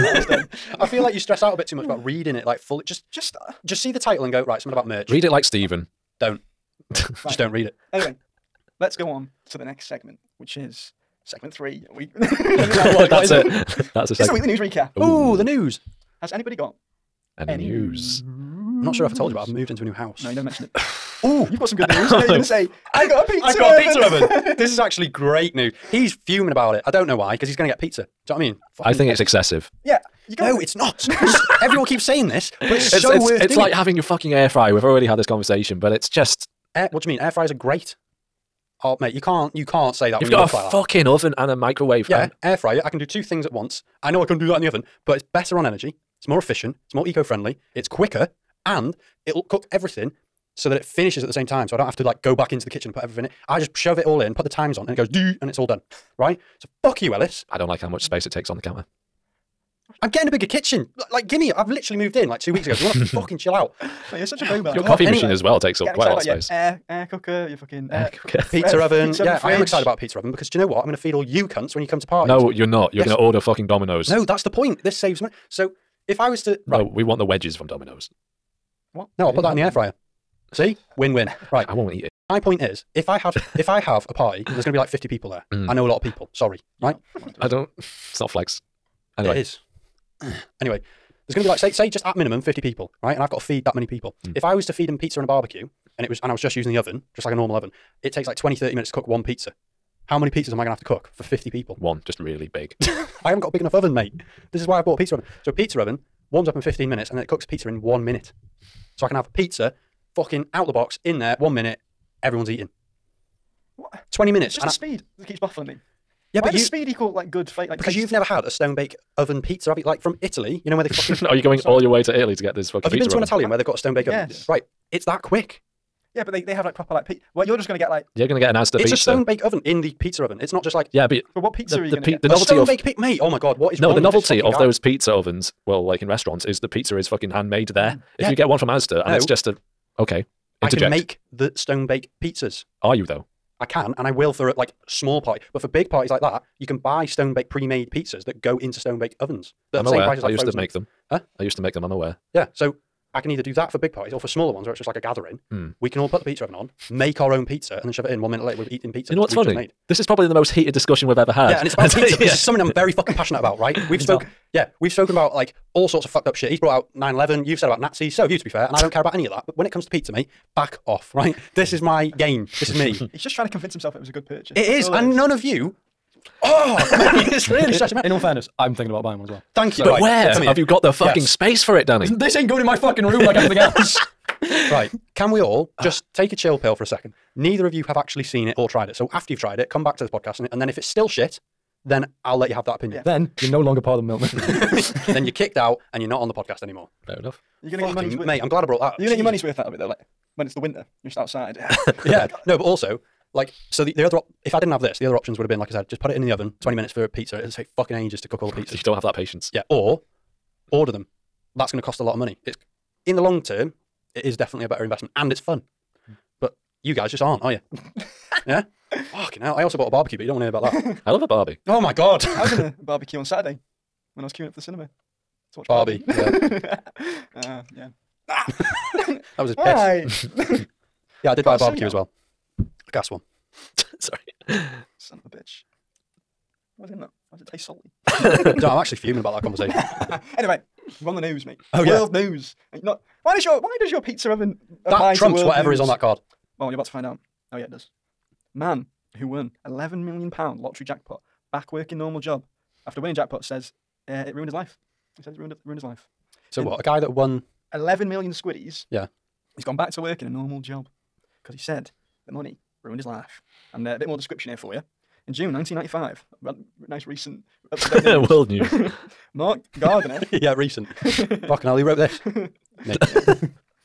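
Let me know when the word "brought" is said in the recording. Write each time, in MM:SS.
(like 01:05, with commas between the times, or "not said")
02:46, 03:18.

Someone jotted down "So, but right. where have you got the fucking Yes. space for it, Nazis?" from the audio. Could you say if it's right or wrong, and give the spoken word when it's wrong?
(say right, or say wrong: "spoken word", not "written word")
wrong: "Danny", not "Nazis".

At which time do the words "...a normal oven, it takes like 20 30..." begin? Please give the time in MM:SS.
01:37.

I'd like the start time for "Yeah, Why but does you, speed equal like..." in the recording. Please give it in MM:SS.
01:56.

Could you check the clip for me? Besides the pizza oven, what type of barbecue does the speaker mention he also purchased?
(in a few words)
A gas one.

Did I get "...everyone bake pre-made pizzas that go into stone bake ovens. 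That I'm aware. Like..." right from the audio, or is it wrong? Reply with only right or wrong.
wrong.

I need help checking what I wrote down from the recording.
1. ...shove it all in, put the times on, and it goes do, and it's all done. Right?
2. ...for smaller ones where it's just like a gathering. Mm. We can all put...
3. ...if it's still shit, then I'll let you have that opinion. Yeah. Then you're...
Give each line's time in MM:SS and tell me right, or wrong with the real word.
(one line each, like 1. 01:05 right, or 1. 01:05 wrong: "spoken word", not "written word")
1. 00:53 right
2. 02:34 right
3. 03:10 right.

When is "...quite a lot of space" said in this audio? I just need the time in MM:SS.
01:05.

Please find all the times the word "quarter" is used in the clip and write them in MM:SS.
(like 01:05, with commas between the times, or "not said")
not said.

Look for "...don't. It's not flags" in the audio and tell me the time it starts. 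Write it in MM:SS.
01:27.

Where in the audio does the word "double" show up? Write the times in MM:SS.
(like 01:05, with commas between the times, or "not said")
not said.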